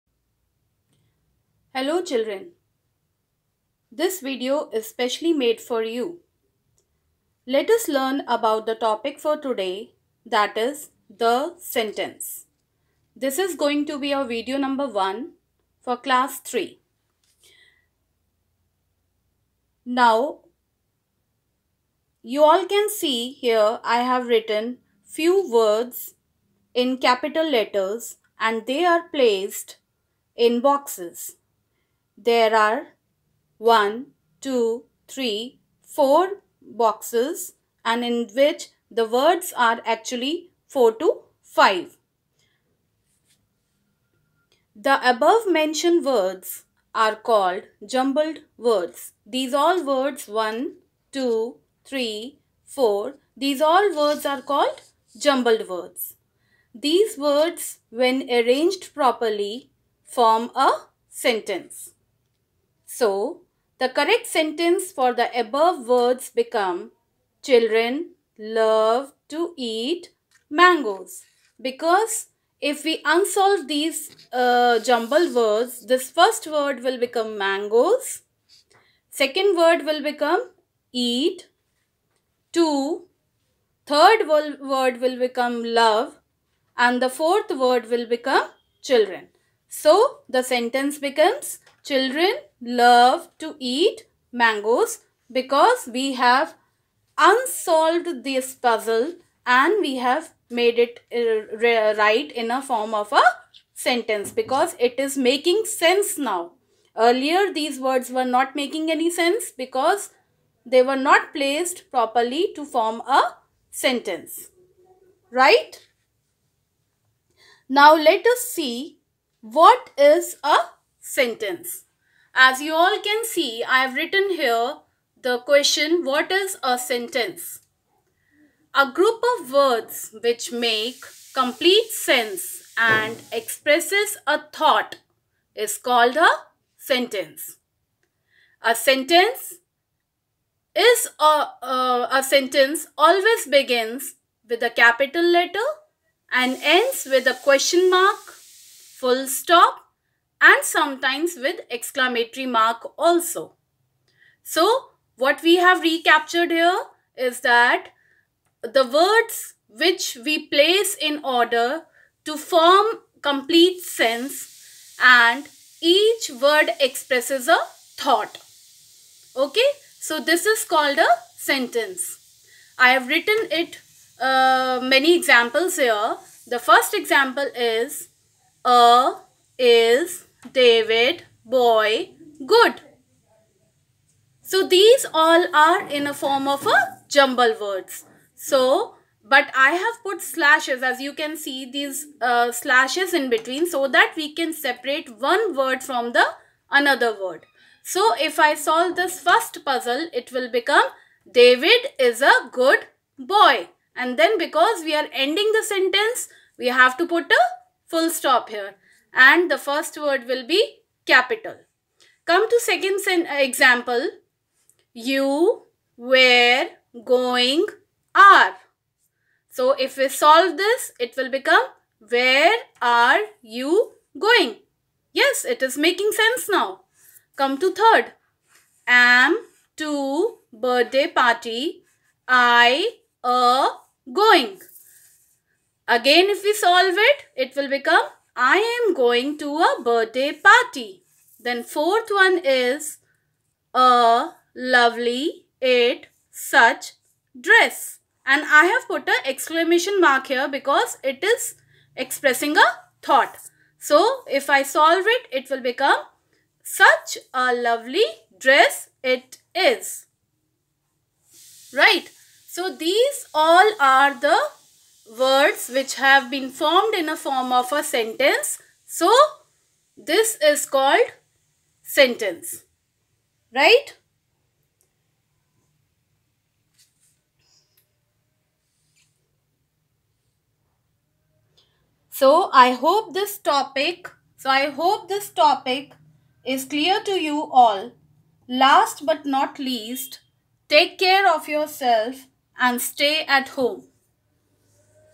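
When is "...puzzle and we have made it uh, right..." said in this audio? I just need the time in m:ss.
1:38.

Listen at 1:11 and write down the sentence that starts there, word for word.
Because if we unsolve these uh, jumbled words, this first word will become mangoes.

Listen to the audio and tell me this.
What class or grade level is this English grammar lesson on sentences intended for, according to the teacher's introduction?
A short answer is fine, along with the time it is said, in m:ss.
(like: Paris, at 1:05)
Class 3, at 0:15.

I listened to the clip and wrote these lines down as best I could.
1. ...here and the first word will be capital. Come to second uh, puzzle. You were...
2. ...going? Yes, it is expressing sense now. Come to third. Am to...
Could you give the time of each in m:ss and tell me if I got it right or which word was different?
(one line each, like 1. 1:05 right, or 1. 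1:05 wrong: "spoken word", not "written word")
1. 3:28 wrong: "example", not "puzzle"
2. 3:44 wrong: "making", not "expressing".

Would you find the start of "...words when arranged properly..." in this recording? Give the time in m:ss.
0:57.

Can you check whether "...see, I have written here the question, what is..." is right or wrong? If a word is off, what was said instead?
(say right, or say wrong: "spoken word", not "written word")
right.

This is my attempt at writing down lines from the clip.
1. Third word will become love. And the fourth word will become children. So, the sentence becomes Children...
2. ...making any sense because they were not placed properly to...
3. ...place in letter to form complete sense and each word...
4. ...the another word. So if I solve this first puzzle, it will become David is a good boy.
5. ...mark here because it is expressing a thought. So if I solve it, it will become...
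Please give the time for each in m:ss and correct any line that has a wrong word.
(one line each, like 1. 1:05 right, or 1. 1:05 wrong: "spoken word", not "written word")
1. 1:23 right
2. 1:48 right
3. 2:40 wrong: "order", not "letter"
4. 3:16 right
5. 4:09 right.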